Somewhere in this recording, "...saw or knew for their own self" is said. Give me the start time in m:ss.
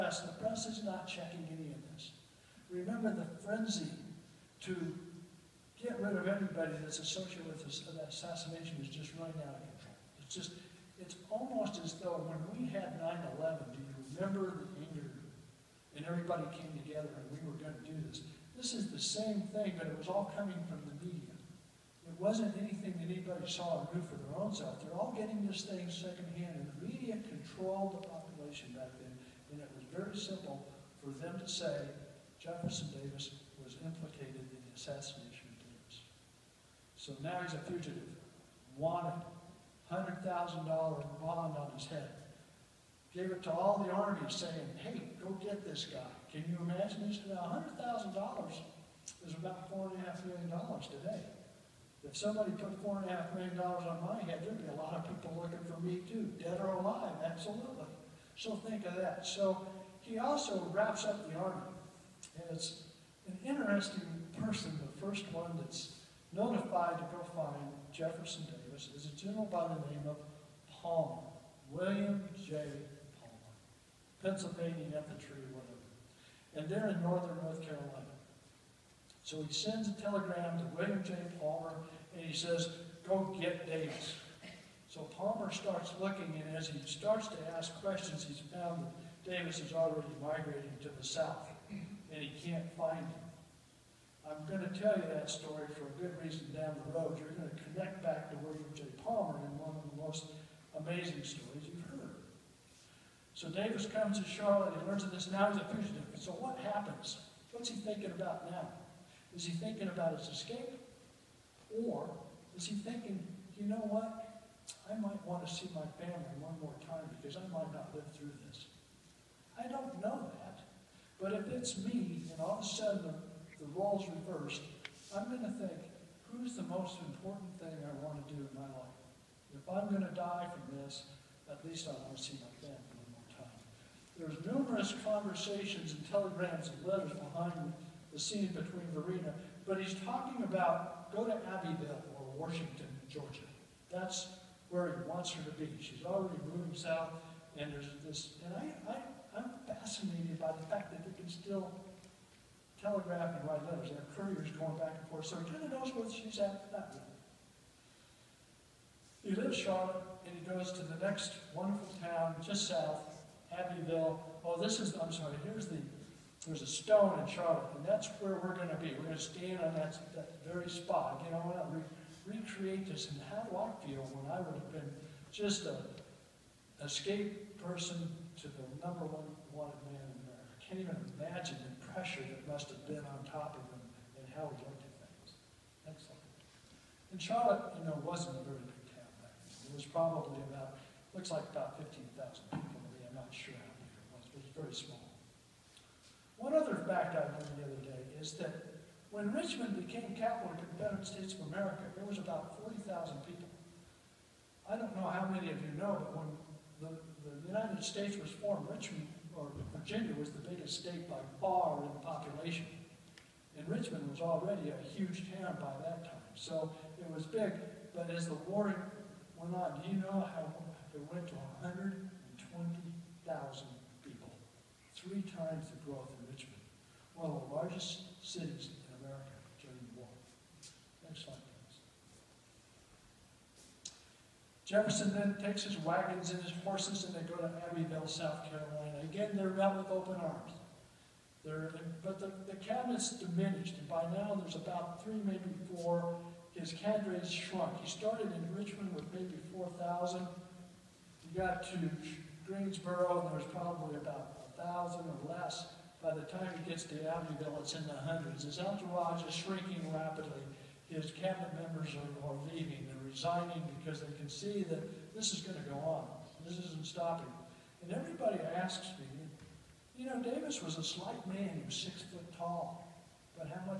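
0:23.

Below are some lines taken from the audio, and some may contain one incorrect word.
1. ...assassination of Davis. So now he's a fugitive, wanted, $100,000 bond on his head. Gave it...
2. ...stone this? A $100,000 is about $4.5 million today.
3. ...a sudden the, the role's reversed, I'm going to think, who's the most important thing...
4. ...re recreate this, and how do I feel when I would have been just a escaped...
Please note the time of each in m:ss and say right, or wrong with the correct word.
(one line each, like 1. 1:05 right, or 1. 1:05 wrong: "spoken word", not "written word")
1. 0:34 right
2. 0:46 wrong: "imagine", not "stone"
3. 2:02 right
4. 2:51 right.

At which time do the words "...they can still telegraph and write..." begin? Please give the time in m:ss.
2:31.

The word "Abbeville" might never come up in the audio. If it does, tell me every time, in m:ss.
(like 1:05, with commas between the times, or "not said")
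2:21, 2:43, 3:57, 4:17.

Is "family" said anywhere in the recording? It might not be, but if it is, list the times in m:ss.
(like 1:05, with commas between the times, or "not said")
1:55, 2:12.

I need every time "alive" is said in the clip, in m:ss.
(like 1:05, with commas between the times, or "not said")
0:56.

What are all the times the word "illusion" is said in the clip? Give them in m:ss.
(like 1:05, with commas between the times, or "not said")
not said.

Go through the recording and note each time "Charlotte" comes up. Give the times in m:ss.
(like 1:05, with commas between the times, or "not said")
1:44, 2:39, 2:47, 3:07.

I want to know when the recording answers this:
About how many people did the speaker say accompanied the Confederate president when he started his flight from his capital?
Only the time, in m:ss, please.
4:09.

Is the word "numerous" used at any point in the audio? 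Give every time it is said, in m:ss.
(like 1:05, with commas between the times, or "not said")
2:14.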